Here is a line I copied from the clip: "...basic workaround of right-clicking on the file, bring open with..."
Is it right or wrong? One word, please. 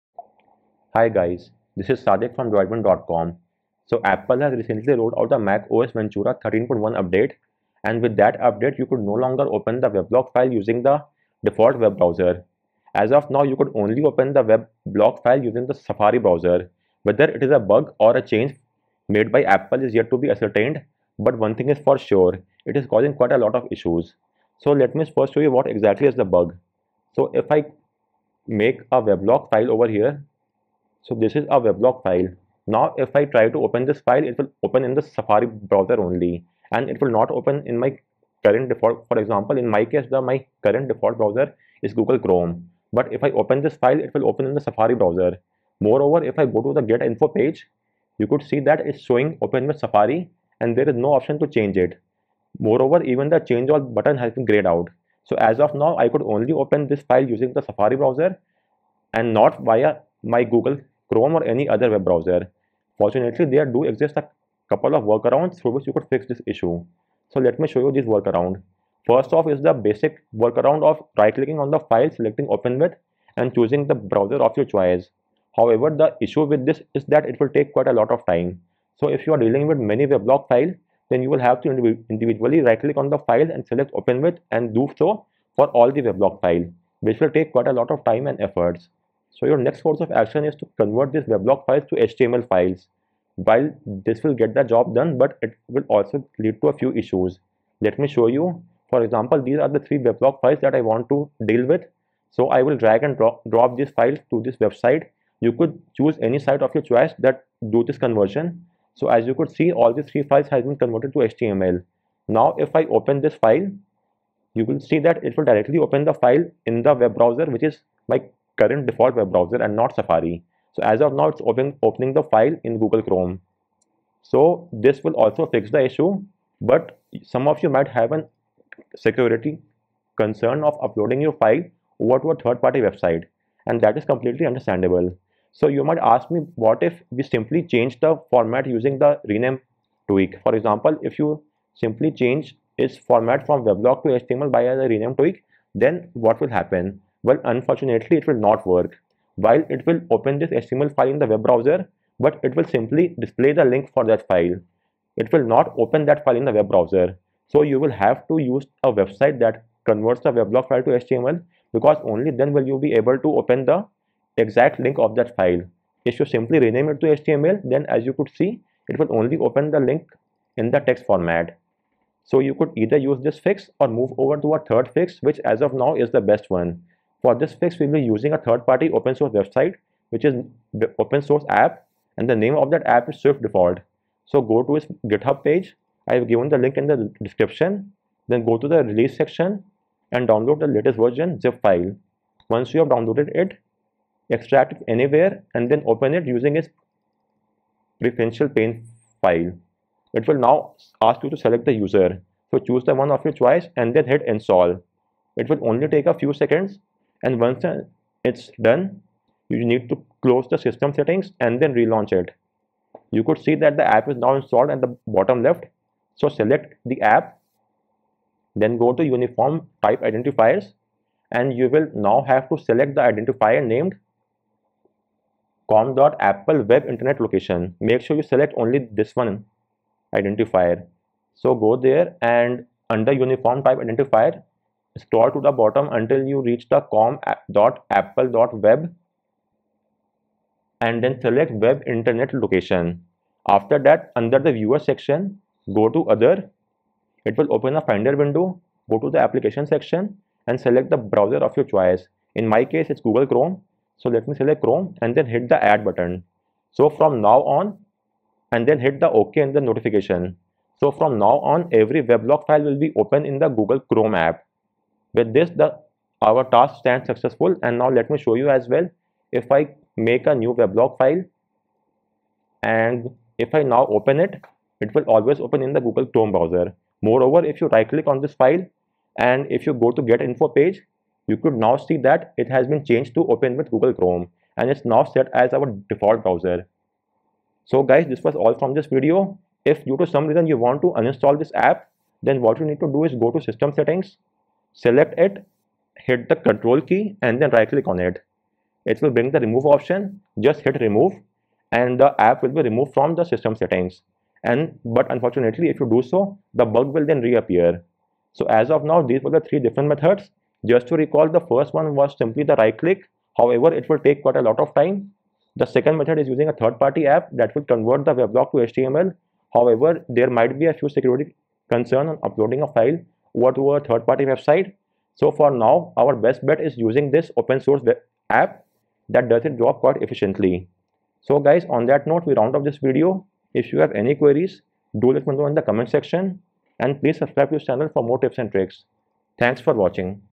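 wrong.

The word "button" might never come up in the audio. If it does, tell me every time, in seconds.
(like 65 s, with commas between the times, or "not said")
53 s, 255 s.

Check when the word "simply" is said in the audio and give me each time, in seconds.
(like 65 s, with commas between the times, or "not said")
137 s, 141 s, 152 s, 166 s, 312 s.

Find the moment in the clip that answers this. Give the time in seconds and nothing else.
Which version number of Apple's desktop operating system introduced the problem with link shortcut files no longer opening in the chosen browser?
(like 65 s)
5 s.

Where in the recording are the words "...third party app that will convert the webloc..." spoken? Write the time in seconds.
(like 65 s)
316 s.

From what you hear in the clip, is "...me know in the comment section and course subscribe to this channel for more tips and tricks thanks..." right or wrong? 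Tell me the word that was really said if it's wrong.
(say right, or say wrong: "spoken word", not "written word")
wrong: "please", not "course".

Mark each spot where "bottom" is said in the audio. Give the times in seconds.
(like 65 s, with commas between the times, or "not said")
215 s, 235 s.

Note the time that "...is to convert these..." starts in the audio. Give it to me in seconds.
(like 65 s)
90 s.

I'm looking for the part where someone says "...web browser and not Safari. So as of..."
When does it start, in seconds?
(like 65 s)
119 s.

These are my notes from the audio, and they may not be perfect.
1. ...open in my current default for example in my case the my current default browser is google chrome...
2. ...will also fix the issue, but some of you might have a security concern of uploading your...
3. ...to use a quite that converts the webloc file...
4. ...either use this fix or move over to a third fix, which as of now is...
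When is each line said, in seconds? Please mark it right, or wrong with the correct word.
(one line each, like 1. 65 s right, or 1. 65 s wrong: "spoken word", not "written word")
1. 37 s right
2. 125 s right
3. 158 s wrong: "website", not "quite"
4. 172 s right.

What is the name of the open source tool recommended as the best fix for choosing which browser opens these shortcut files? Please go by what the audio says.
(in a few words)
Swift Default.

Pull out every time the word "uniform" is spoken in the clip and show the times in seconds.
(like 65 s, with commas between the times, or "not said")
219 s, 233 s.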